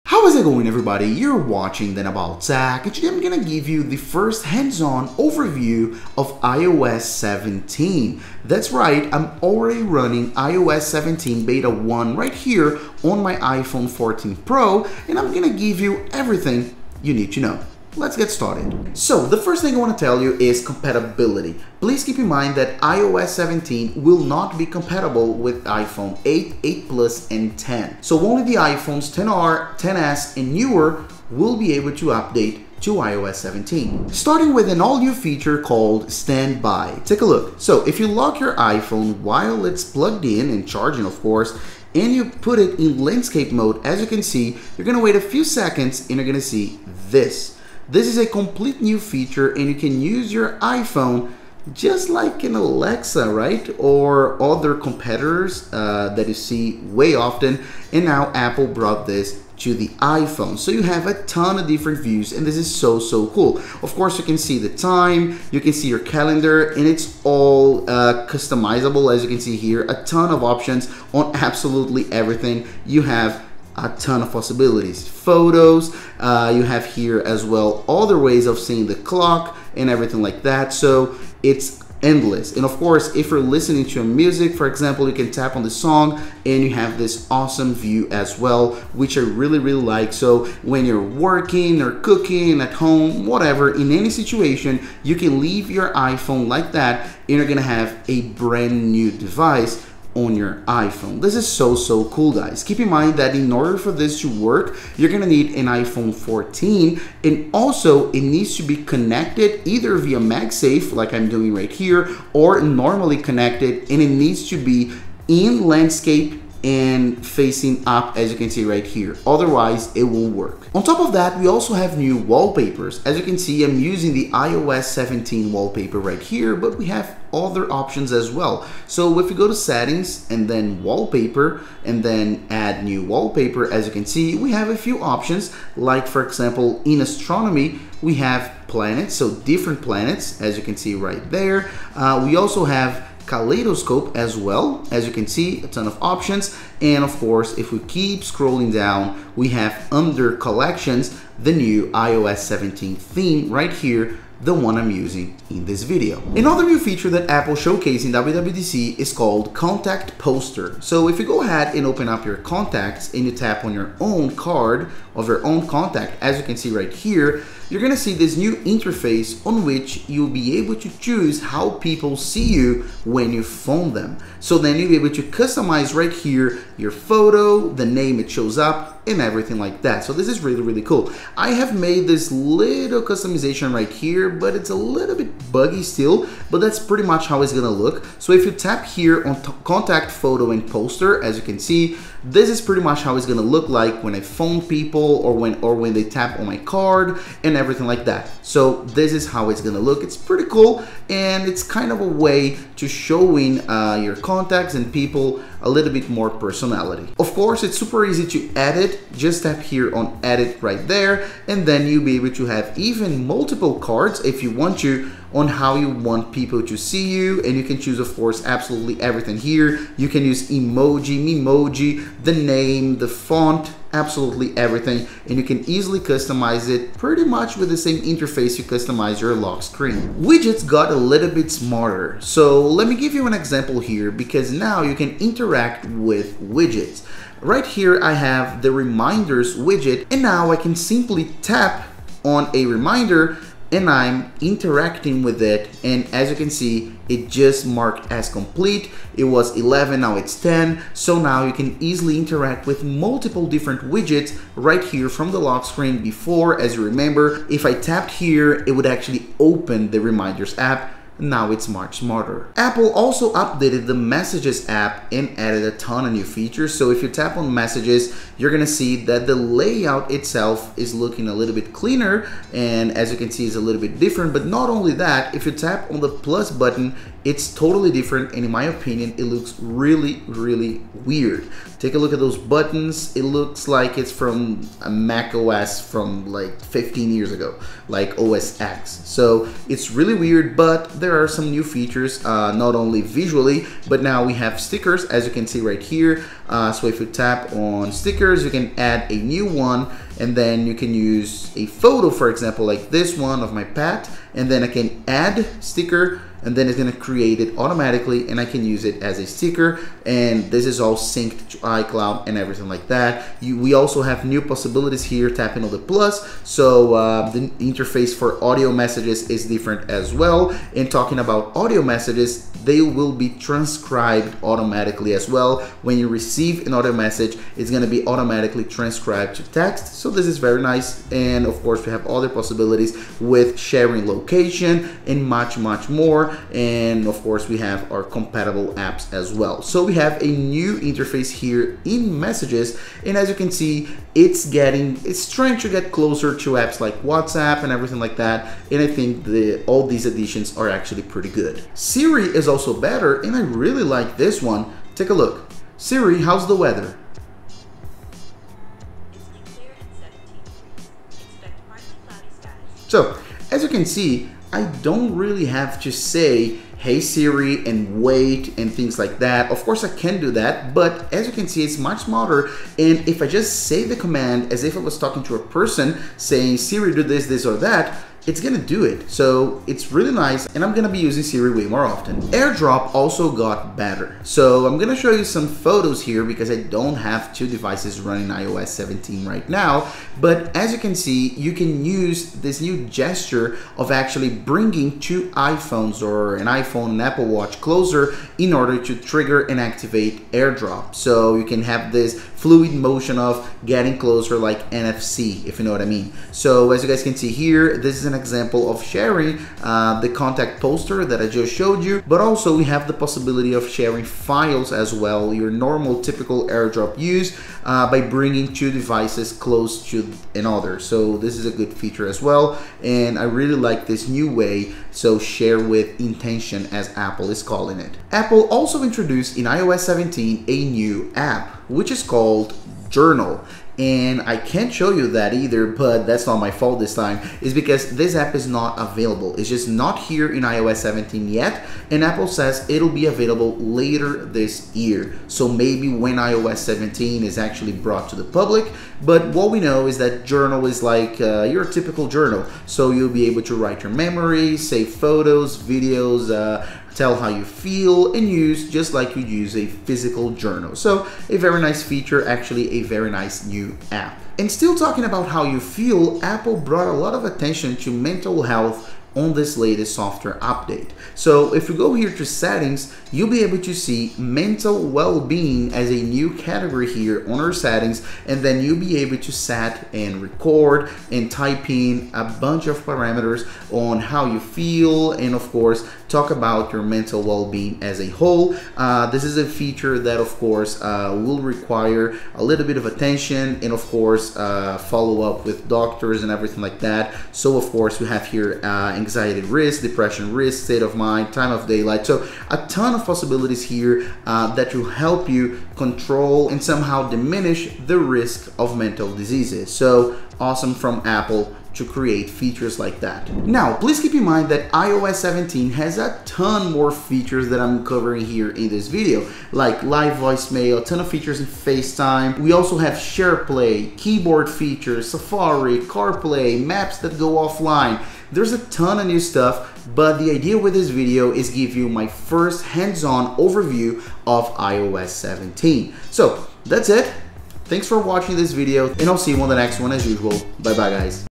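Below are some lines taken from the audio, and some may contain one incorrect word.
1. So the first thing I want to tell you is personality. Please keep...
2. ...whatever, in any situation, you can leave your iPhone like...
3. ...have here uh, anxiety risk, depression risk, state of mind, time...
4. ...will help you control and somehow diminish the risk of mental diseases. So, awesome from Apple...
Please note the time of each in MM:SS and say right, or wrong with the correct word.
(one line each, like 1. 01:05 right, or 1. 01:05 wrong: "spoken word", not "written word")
1. 00:18 wrong: "compatibility", not "personality"
2. 01:33 right
3. 08:18 right
4. 08:24 right.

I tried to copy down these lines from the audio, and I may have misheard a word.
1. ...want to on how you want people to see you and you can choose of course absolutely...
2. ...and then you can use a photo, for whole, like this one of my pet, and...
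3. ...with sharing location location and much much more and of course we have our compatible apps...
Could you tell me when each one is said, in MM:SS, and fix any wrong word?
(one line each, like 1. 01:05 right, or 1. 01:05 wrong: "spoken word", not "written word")
1. 03:34 right
2. 05:00 wrong: "example", not "whole"
3. 05:33 right.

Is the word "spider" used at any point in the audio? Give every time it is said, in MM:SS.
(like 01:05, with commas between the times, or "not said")
not said.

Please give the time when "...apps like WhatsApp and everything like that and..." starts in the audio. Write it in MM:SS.
05:46.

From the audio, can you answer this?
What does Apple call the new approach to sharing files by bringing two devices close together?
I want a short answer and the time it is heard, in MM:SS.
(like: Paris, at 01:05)
Share with intention, at 07:05.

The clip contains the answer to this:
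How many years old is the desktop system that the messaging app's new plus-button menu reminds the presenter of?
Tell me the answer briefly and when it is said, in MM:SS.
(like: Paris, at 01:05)
15, at 04:46.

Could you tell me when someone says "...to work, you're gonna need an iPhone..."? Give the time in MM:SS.
01:44.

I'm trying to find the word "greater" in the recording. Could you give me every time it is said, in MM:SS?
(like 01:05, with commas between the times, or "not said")
not said.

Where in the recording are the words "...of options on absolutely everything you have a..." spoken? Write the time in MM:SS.
01:10.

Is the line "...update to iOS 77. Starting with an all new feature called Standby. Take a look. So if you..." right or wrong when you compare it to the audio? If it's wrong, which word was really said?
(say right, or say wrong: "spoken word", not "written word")
wrong: "17", not "77".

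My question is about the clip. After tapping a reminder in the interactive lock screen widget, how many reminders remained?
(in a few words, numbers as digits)
10.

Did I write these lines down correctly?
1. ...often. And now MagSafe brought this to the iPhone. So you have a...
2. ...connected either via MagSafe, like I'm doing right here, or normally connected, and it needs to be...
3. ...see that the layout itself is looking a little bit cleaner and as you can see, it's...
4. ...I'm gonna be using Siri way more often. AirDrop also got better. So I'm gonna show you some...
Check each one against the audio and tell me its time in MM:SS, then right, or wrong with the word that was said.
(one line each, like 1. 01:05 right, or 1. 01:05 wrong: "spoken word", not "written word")
1. 00:57 wrong: "Apple", not "MagSafe"
2. 01:48 right
3. 04:28 right
4. 06:20 right.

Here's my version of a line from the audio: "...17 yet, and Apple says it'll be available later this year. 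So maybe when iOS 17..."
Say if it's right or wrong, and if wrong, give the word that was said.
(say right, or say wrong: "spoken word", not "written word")
right.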